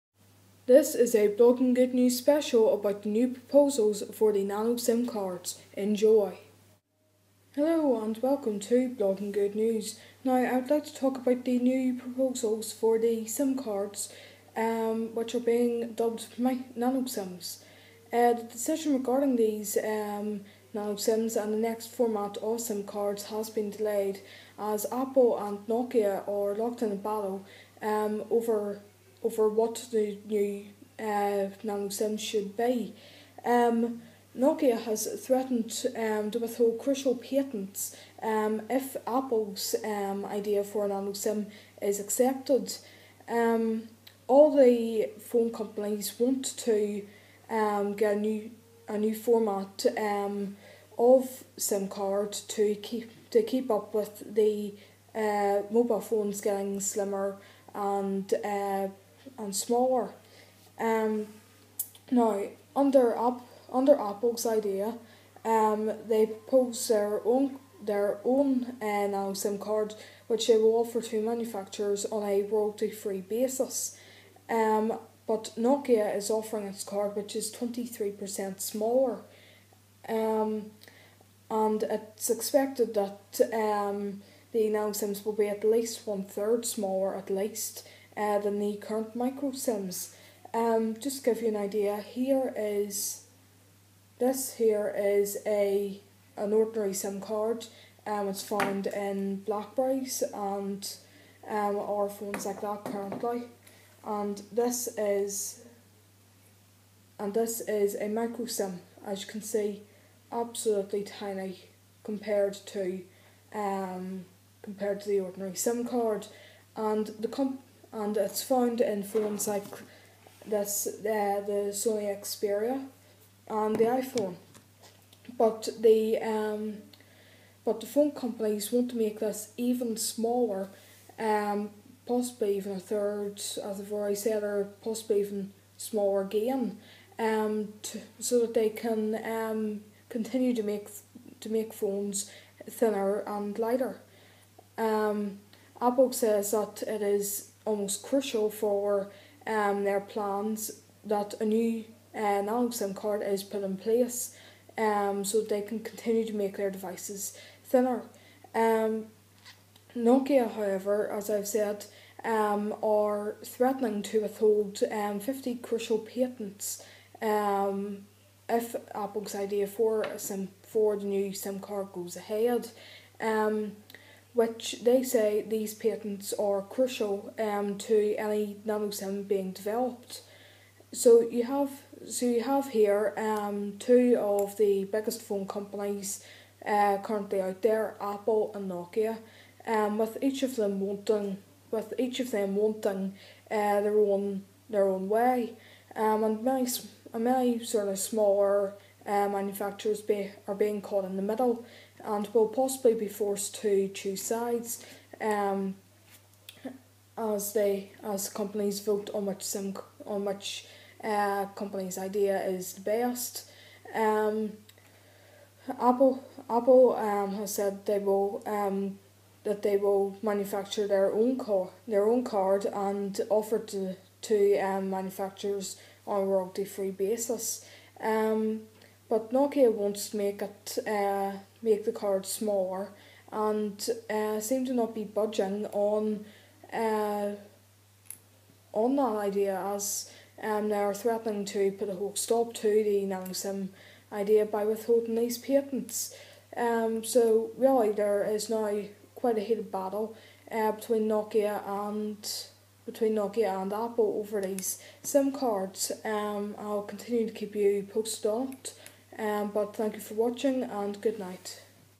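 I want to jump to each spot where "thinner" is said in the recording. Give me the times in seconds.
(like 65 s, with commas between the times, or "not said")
142 s, 157 s.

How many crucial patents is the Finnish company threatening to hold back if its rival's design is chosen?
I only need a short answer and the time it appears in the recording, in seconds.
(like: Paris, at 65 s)
50, at 165 s.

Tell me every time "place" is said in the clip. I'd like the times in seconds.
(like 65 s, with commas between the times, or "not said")
153 s.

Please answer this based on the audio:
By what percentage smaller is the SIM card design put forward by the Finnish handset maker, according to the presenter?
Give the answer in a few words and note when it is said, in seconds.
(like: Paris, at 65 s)
23%, at 77 s.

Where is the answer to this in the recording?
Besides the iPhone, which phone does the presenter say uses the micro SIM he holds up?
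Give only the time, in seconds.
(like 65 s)
121 s.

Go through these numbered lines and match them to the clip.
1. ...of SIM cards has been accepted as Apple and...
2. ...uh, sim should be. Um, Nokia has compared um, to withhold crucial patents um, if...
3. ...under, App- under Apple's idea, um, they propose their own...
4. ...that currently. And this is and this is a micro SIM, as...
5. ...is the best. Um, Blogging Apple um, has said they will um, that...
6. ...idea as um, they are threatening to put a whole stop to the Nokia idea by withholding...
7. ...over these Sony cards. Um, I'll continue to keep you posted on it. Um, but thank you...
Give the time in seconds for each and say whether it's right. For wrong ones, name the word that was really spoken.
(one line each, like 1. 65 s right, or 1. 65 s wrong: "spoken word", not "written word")
1. 22 s wrong: "delayed", not "accepted"
2. 30 s wrong: "threatened", not "compared"
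3. 62 s right
4. 102 s right
5. 212 s wrong: "Apple", not "Blogging"
6. 239 s wrong: "Nanosim", not "Nokia"
7. 254 s wrong: "SIM", not "Sony".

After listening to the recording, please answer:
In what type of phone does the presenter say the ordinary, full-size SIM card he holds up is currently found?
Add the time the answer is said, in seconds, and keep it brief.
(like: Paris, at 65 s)
Blackberries, at 99 s.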